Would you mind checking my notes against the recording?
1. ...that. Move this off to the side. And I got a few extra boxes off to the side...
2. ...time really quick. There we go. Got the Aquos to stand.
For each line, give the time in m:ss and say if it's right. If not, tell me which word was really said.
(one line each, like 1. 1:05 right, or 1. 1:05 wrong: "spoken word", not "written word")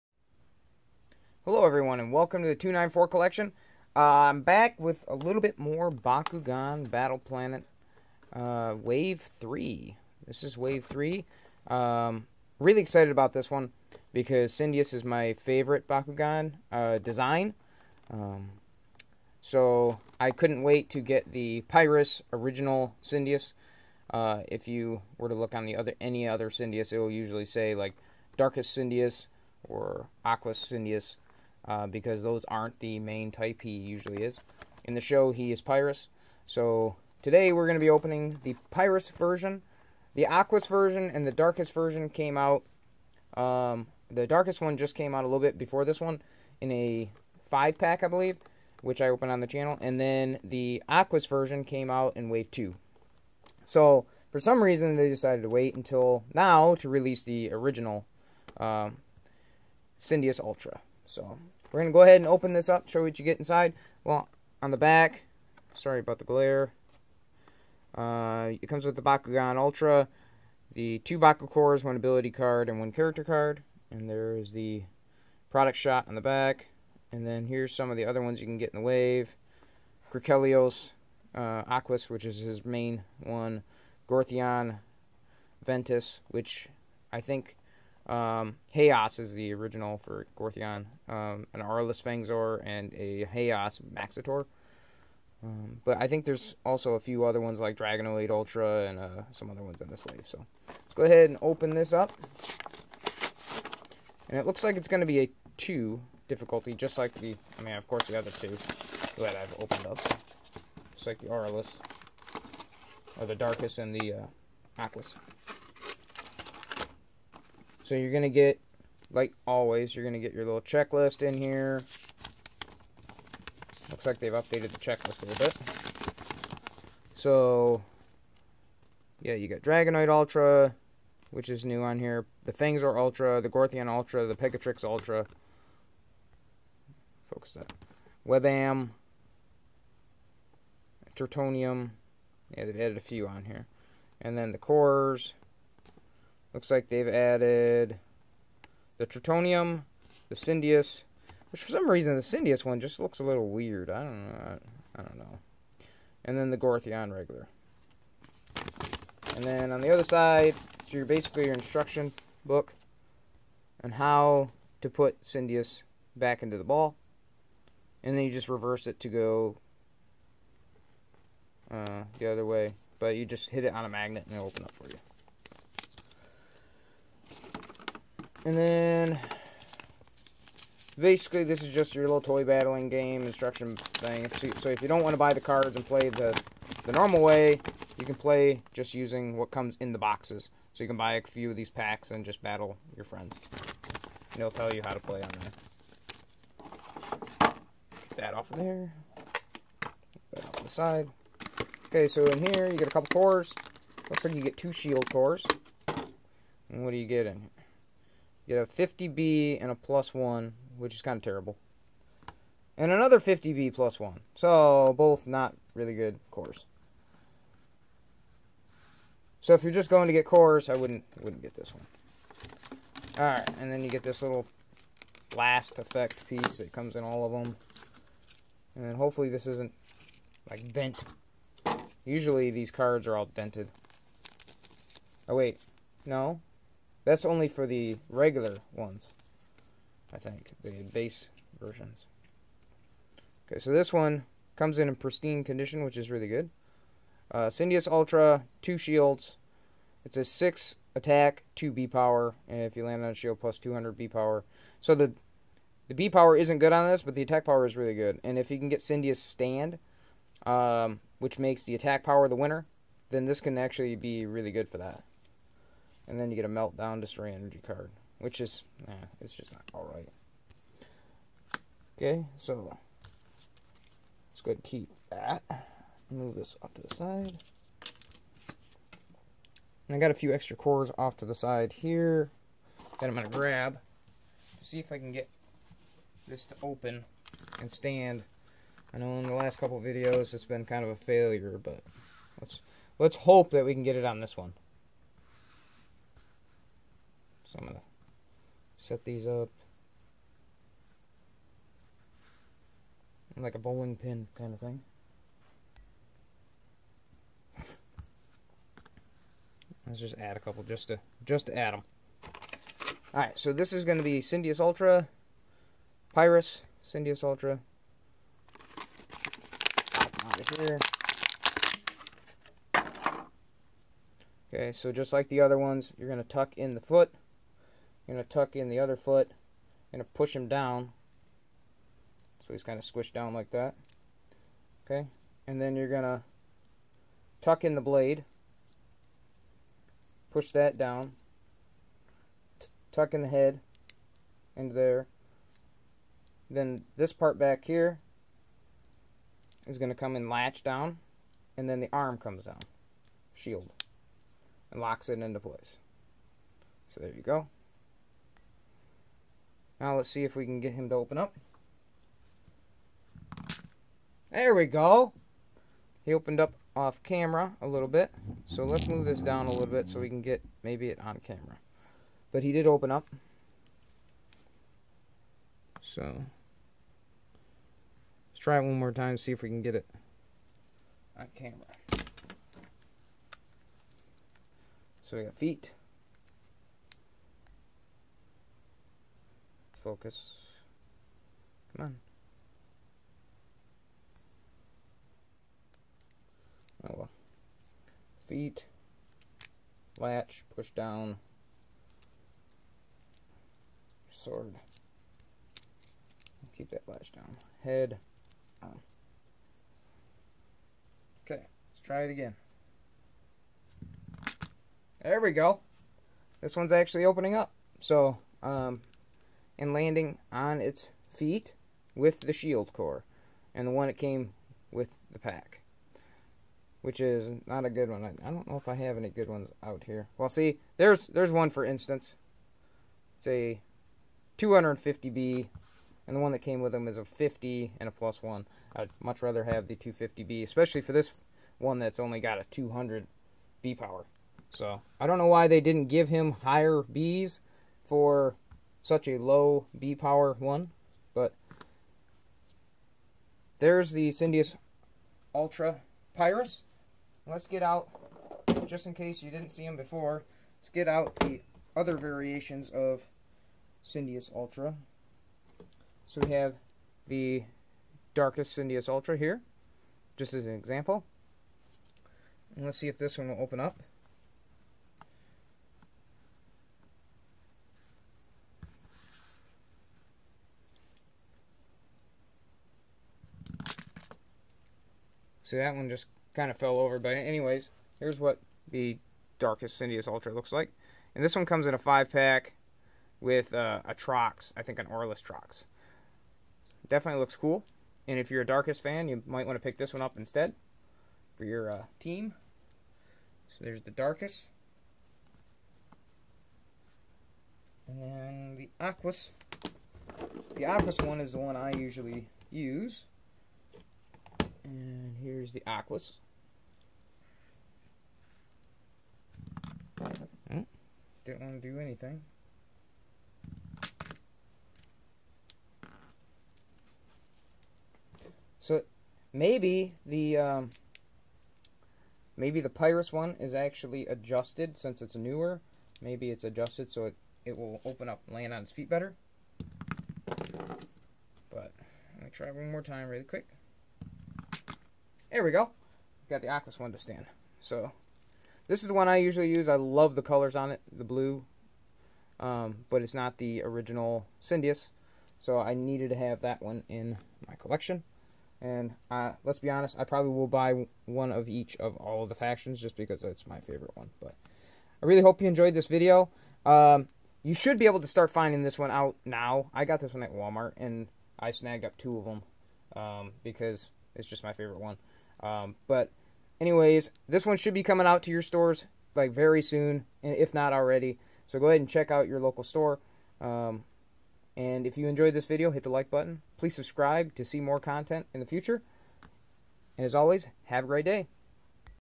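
1. 4:35 wrong: "cores", not "boxes"
2. 9:02 right.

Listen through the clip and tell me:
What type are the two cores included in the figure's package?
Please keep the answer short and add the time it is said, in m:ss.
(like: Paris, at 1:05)
shield cores, at 3:24.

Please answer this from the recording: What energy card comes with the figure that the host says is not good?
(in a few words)
meltdown destroy.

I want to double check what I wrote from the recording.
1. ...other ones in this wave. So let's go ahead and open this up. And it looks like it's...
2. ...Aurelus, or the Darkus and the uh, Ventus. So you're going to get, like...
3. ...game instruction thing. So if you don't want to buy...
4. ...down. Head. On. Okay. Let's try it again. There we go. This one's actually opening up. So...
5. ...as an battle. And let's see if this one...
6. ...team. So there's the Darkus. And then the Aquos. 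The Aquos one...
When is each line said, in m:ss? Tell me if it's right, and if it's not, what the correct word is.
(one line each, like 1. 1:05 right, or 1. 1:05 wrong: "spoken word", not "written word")
1. 1:39 right
2. 1:51 wrong: "Aquos", not "Ventus"
3. 3:02 right
4. 6:47 right
5. 7:50 wrong: "example", not "battle"
6. 8:21 right.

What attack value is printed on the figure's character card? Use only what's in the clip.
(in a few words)
6.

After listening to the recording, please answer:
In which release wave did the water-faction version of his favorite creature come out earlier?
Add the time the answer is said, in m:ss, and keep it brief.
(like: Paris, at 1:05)
Wave 2, at 0:52.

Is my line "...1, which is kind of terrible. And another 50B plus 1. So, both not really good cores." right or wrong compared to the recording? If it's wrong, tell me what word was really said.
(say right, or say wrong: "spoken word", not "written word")
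right.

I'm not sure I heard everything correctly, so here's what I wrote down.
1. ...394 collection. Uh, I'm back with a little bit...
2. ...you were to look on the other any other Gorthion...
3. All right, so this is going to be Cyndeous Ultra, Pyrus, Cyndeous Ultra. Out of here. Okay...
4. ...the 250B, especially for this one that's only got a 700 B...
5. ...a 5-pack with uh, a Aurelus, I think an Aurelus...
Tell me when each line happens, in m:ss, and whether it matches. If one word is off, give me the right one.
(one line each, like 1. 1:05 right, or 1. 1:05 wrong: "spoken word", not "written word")
1. 0:02 wrong: "294", not "394"
2. 0:24 wrong: "Cyndeous", not "Gorthion"
3. 5:13 right
4. 7:19 wrong: "200", not "700"
5. 8:11 wrong: "Trox", not "Aurelus".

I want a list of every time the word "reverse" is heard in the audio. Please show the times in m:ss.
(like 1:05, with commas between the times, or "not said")
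2:48.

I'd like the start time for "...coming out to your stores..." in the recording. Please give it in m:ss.
9:37.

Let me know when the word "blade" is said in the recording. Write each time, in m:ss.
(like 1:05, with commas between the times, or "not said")
5:37.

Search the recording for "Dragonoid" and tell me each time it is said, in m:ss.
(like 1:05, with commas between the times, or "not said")
1:37, 2:09.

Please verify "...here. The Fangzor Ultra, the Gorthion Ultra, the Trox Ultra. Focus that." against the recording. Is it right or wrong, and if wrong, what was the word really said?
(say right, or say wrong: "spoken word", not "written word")
wrong: "Pegatrix", not "Trox".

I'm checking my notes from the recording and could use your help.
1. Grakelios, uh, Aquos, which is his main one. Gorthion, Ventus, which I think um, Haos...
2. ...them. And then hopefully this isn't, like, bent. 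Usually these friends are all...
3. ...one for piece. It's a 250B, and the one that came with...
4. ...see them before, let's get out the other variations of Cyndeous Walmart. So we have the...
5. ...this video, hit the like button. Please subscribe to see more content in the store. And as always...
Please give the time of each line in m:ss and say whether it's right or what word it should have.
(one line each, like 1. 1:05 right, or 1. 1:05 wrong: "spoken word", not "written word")
1. 1:20 right
2. 3:47 wrong: "cards", not "friends"
3. 7:11 wrong: "instance", not "piece"
4. 7:39 wrong: "Ultra", not "Walmart"
5. 9:45 wrong: "future", not "store".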